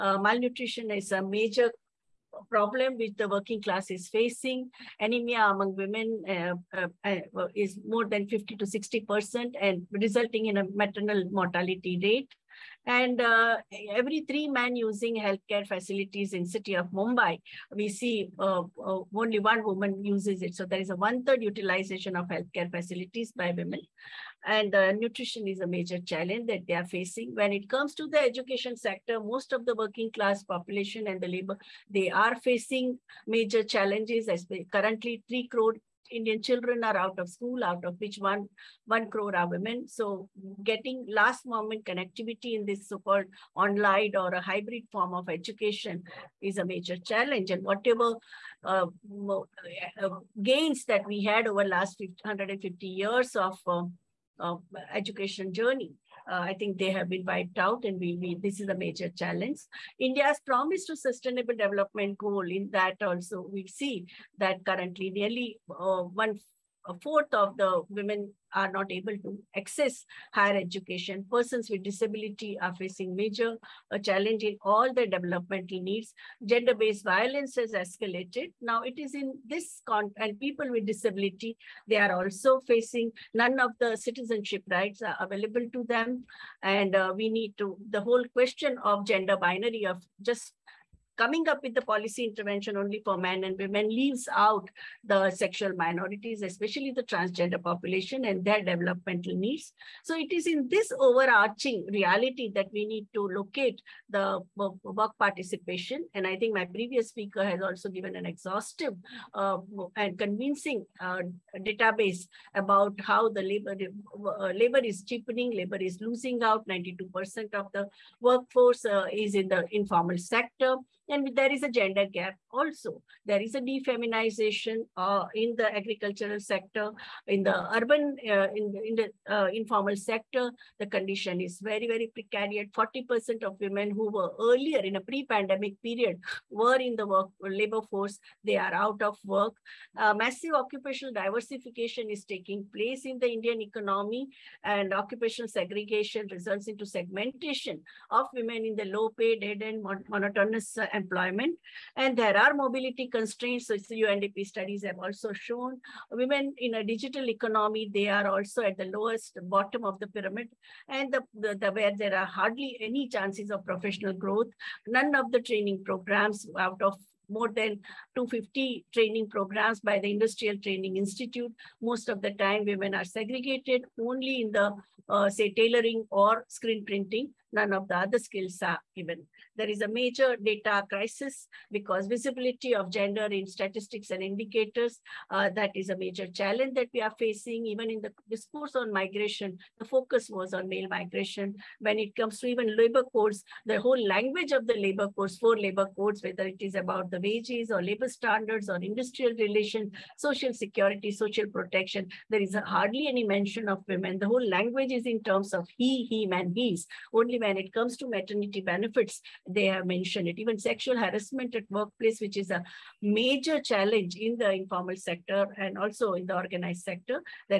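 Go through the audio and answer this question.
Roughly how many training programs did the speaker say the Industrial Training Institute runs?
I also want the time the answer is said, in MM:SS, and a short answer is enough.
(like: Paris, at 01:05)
more than 250, at 02:47.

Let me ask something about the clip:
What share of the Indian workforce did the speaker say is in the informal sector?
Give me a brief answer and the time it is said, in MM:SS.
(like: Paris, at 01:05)
92%, at 01:56.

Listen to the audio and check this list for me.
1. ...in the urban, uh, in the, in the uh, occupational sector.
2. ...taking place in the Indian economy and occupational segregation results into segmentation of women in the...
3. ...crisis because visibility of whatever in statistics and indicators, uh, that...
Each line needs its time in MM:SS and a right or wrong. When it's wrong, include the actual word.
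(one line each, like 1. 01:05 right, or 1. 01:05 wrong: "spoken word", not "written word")
1. 02:07 wrong: "informal", not "occupational"
2. 02:22 right
3. 03:00 wrong: "gender", not "whatever".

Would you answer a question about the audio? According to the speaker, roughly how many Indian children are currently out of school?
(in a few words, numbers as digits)
3 crore.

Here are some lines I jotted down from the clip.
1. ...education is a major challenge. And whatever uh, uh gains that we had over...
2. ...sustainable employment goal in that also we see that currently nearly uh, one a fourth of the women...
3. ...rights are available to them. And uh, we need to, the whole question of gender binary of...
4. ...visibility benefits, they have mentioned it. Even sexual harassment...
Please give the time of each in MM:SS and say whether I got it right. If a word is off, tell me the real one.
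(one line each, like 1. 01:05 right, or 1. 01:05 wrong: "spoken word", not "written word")
1. 00:45 right
2. 01:00 wrong: "development", not "employment"
3. 01:24 right
4. 03:28 wrong: "maternity", not "visibility".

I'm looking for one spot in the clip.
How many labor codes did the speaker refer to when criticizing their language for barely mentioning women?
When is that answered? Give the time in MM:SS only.
03:15.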